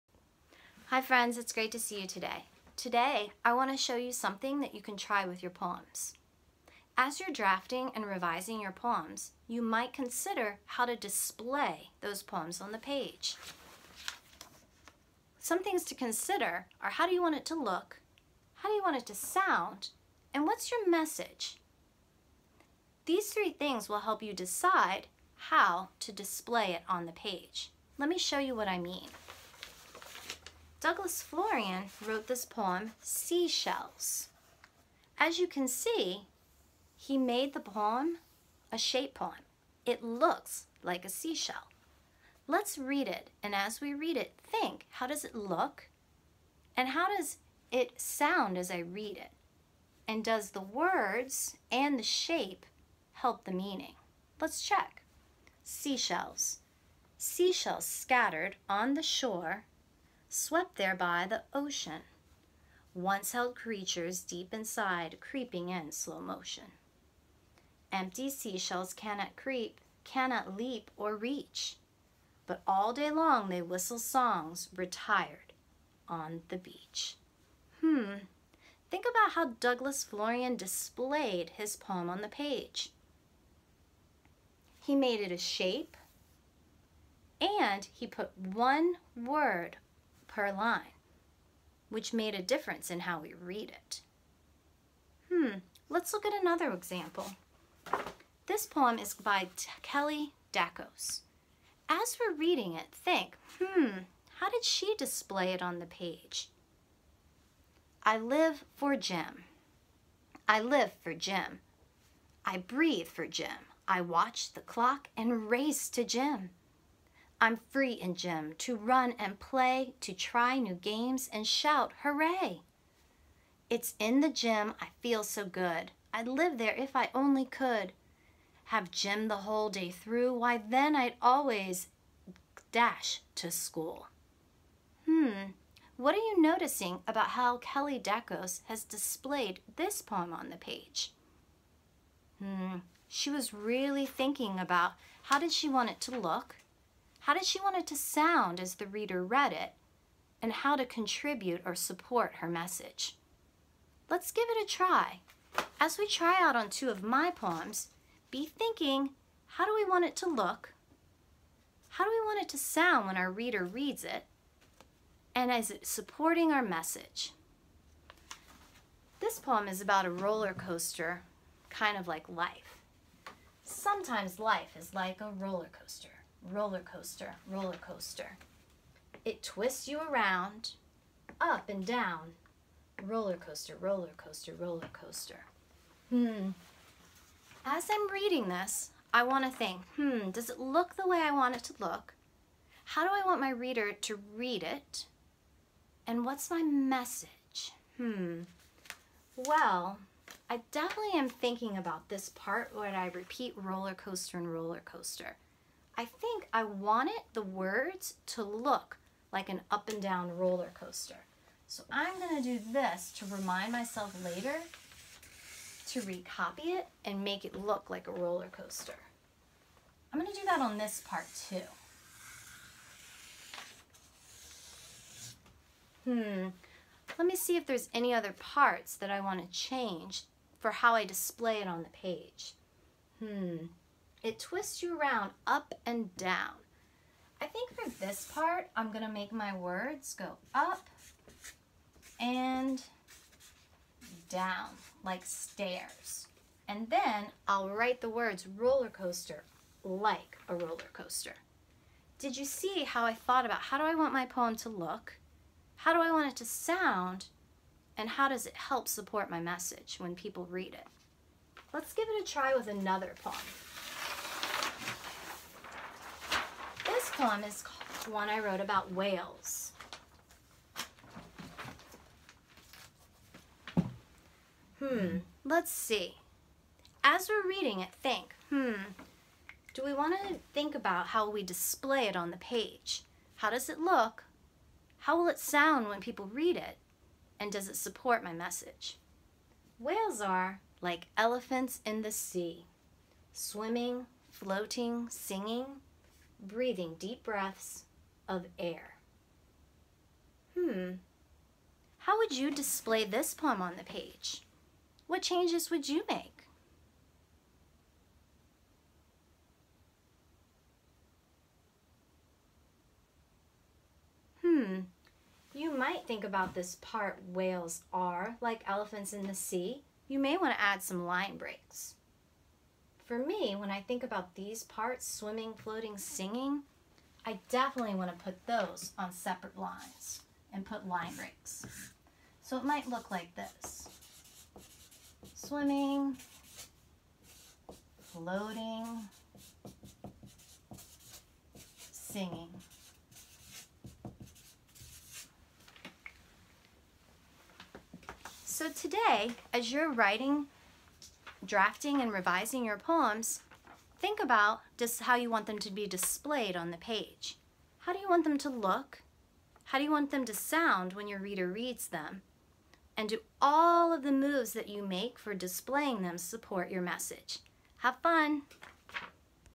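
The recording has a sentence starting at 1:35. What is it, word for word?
Hmm, let's look at another example.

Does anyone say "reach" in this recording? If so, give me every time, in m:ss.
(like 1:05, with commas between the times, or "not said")
1:11.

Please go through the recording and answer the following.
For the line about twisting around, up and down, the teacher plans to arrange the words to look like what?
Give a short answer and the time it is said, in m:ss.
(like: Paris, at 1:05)
stairs, at 4:05.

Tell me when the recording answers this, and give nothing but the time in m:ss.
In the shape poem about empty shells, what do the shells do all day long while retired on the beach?
1:13.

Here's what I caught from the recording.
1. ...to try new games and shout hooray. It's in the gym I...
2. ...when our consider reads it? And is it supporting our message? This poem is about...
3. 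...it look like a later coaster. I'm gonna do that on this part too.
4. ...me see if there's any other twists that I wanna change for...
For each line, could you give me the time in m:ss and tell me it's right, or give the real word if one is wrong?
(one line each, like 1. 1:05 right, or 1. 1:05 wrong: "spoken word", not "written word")
1. 2:00 right
2. 2:43 wrong: "reader", not "consider"
3. 3:37 wrong: "roller", not "later"
4. 3:47 wrong: "parts", not "twists".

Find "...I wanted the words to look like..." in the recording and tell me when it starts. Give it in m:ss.
3:26.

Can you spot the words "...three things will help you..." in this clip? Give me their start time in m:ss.
0:23.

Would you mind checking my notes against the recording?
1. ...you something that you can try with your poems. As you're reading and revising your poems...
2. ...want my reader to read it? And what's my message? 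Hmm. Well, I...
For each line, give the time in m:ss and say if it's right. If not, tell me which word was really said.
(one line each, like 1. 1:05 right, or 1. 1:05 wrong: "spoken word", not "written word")
1. 0:03 wrong: "drafting", not "reading"
2. 3:13 right.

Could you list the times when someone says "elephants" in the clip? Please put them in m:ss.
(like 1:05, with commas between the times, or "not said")
4:51, 5:18.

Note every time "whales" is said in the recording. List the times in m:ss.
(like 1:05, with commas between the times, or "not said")
4:28, 4:49, 5:17.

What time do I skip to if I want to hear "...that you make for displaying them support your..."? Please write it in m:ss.
6:04.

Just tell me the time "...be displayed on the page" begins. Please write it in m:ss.
5:55.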